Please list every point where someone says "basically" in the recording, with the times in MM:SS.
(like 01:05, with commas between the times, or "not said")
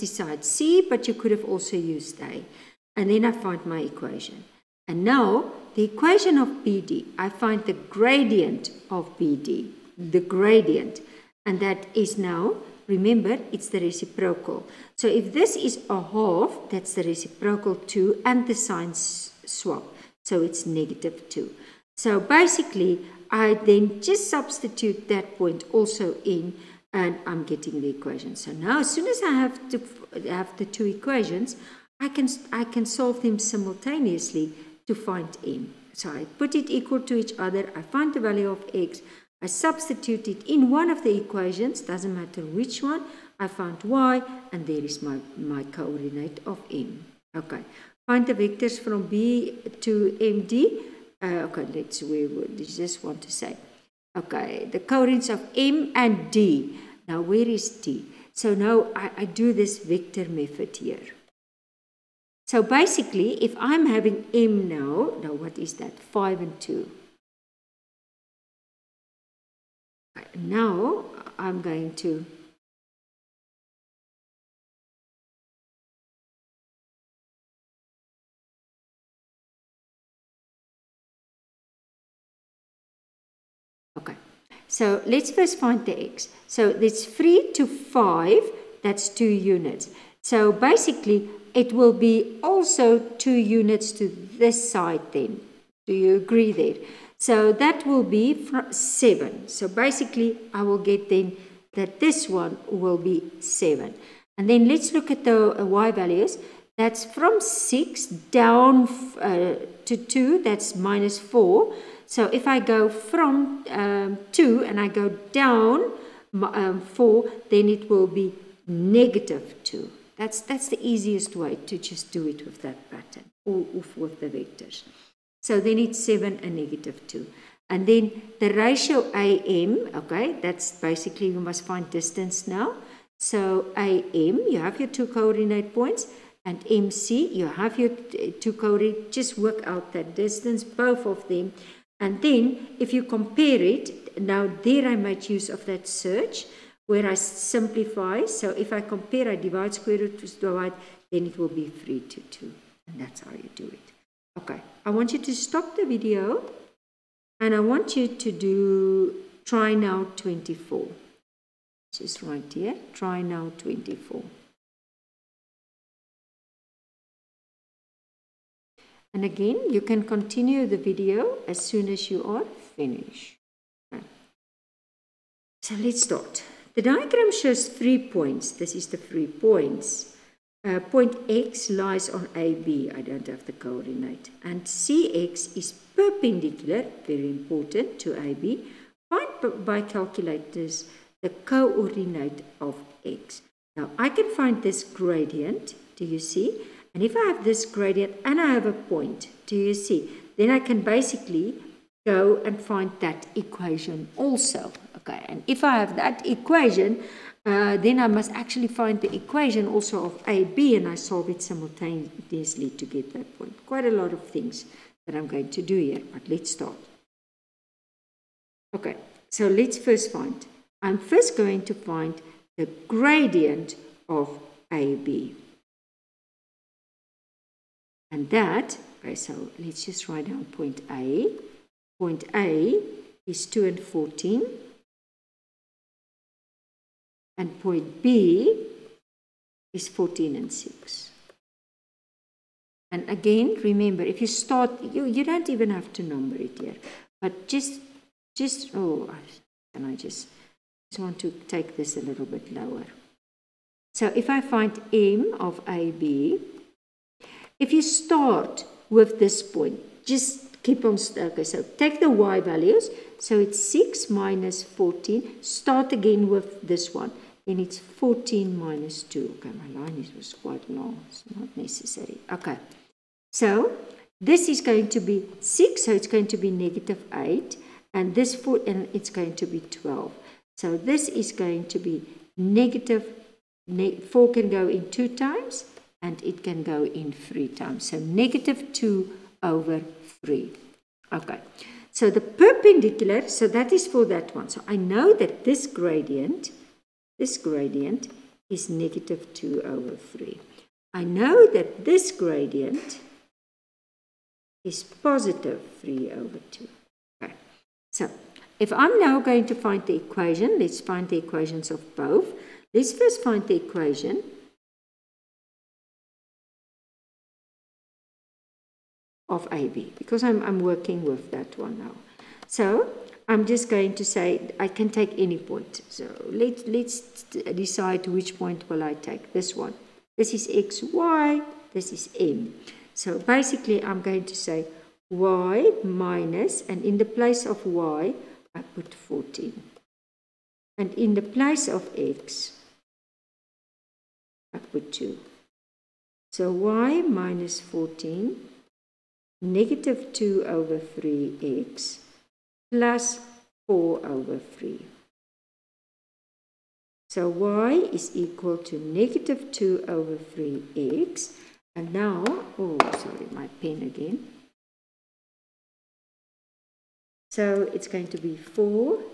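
00:22, 01:02, 01:30, 01:39, 02:10, 03:20, 05:33.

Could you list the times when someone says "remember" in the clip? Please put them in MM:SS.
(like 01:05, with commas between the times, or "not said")
00:12, 04:03.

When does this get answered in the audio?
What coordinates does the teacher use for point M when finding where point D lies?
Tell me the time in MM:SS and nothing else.
01:05.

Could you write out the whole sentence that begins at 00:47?
Okay, Find the vectors from B to MD.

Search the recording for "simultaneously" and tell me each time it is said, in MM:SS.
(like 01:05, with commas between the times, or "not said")
00:33, 03:31.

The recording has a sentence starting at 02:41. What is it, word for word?
Just right here, try now 24.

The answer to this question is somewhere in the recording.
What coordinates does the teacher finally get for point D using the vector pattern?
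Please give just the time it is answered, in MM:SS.
02:06.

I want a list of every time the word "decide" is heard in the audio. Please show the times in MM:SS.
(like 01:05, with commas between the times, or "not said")
00:00, 05:27.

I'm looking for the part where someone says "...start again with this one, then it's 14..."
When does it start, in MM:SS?
04:25.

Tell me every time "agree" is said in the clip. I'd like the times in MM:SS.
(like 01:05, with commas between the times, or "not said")
01:36.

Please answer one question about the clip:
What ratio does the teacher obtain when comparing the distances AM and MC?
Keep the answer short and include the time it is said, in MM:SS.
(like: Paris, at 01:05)
3 to 2, at 02:31.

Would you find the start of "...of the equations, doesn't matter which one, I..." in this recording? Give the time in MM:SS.
00:40.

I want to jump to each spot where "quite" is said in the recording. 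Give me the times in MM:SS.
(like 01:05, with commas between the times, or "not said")
03:33, 04:30.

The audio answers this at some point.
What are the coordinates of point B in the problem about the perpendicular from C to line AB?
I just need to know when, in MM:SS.
03:59.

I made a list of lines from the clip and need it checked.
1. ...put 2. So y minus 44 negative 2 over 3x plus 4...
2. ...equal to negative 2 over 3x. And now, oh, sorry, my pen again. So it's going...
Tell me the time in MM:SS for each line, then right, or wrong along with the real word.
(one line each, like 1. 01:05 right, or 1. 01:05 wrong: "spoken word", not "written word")
1. 05:44 wrong: "14", not "44"
2. 05:58 right.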